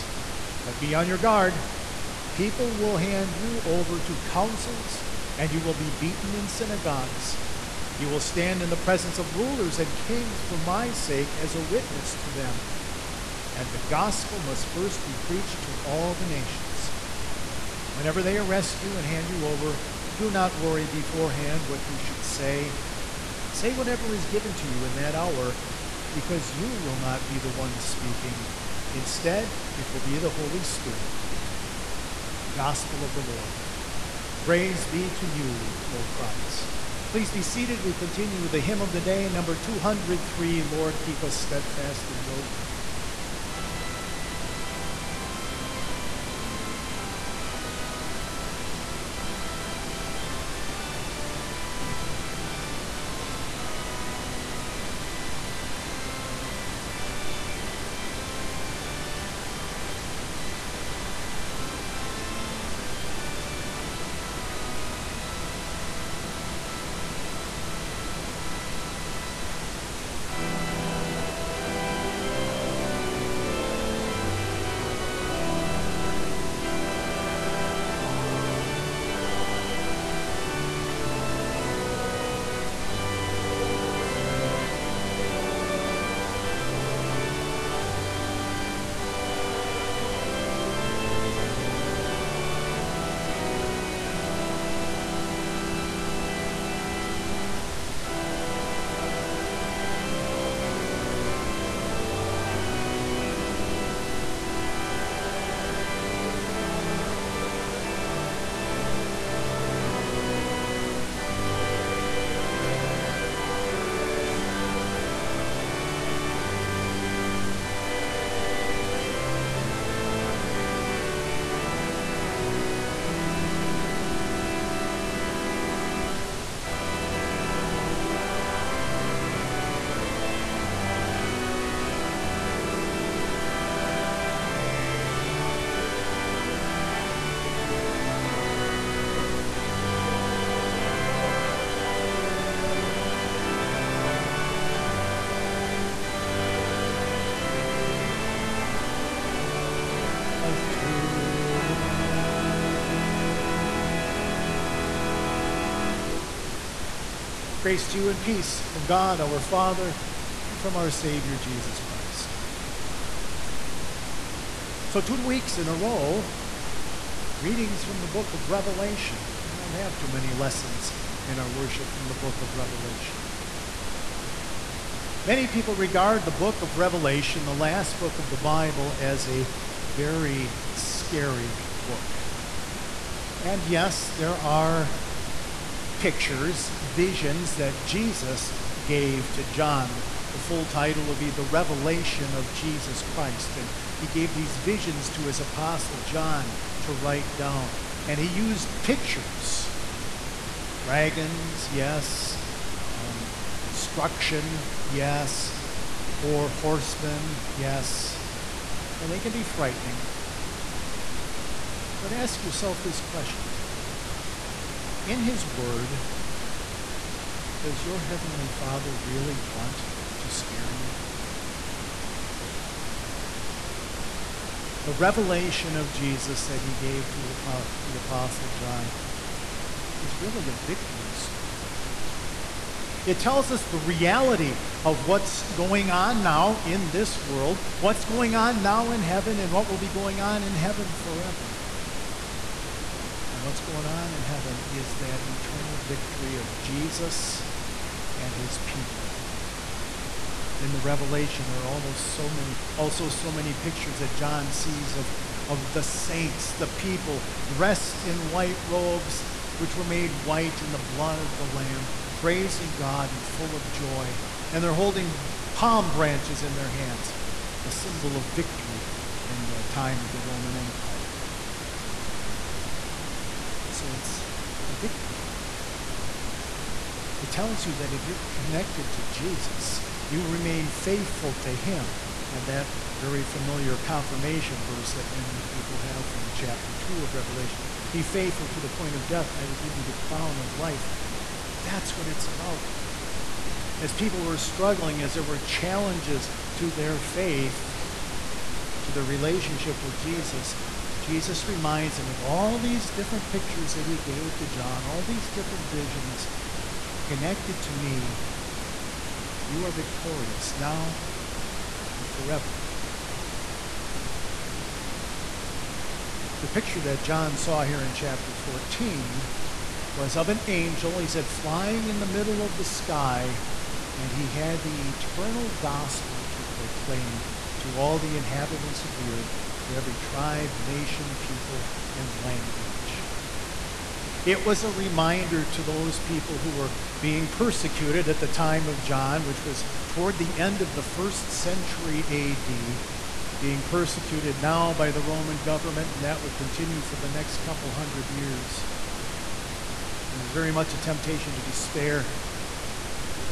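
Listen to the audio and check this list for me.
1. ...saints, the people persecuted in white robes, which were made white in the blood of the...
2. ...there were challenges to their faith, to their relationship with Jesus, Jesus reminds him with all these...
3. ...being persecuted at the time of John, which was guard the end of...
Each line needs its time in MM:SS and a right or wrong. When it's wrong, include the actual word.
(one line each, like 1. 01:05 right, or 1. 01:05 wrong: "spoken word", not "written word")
1. 04:15 wrong: "dressed", not "persecuted"
2. 04:55 right
3. 05:36 wrong: "toward", not "guard".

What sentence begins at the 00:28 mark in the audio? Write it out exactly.
Instead, it will be the Holy Spirit.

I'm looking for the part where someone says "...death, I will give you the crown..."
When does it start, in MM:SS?
04:49.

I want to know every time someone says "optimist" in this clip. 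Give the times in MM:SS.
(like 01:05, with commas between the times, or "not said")
not said.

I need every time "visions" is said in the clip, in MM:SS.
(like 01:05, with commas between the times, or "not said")
03:06, 03:14, 05:05.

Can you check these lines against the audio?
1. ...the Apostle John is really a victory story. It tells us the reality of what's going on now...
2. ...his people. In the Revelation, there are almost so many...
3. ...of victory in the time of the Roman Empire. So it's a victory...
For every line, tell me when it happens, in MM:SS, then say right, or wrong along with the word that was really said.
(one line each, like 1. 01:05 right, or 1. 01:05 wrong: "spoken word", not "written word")
1. 03:47 right
2. 04:08 right
3. 04:28 right.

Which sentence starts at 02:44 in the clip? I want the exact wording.
So, two weeks in a row, readings from the book of Revelation.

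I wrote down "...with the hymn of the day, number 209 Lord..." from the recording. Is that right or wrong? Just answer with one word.
wrong.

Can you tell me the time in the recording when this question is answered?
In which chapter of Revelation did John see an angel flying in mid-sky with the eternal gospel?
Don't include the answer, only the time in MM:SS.
05:17.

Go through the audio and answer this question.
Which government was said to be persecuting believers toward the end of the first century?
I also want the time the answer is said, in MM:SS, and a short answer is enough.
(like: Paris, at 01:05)
Roman government, at 05:45.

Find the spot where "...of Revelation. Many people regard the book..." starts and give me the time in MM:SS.
02:52.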